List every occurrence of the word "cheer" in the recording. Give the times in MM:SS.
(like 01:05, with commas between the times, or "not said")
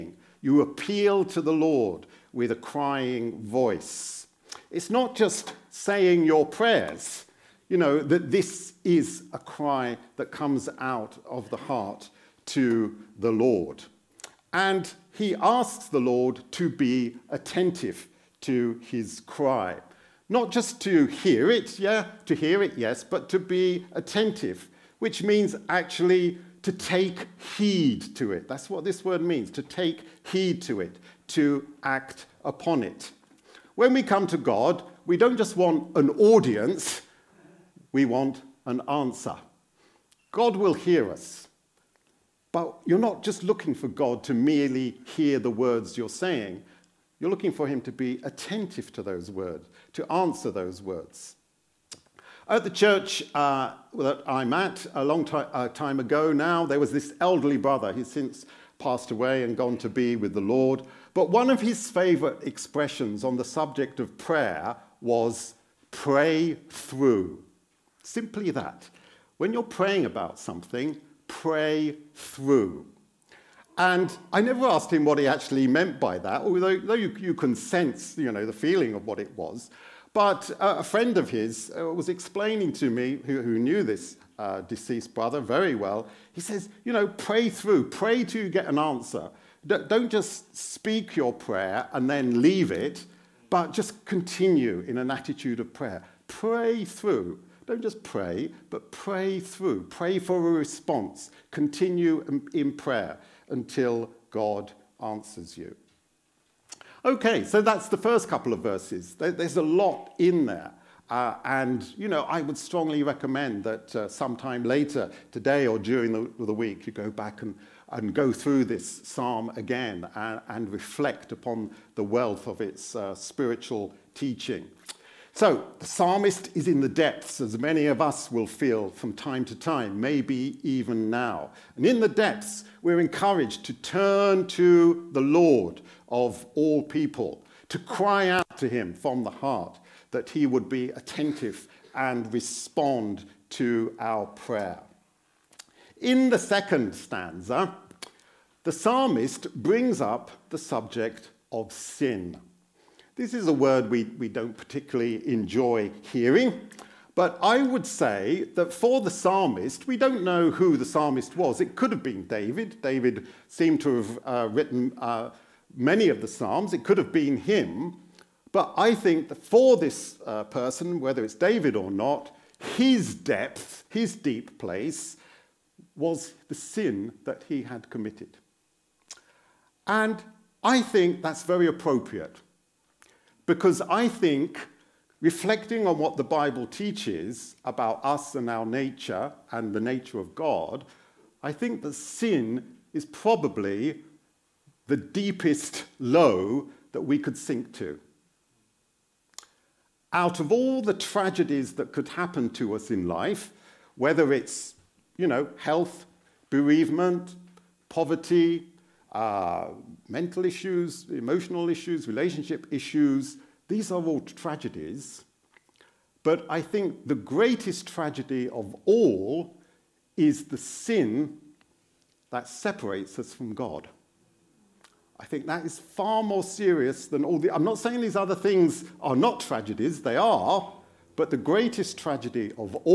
not said.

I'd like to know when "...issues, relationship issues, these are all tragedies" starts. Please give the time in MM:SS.
03:31.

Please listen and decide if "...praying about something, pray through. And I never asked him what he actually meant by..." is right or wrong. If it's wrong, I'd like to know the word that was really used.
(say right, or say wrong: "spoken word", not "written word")
right.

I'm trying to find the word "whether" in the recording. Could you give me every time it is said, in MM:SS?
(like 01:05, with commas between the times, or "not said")
02:51, 03:23.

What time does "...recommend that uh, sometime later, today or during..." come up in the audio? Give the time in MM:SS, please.
01:53.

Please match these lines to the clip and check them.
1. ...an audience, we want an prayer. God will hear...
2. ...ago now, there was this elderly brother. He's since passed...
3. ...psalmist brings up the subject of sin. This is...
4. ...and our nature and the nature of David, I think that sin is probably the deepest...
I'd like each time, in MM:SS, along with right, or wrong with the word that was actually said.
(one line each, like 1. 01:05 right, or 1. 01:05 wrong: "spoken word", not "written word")
1. 00:35 wrong: "answer", not "prayer"
2. 00:56 right
3. 02:28 right
4. 03:08 wrong: "God", not "David".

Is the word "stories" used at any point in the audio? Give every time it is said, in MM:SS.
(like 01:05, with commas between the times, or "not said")
not said.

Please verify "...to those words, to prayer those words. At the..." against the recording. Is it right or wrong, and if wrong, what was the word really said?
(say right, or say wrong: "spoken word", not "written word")
wrong: "answer", not "prayer".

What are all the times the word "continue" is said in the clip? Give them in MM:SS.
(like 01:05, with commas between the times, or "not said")
01:34, 01:41.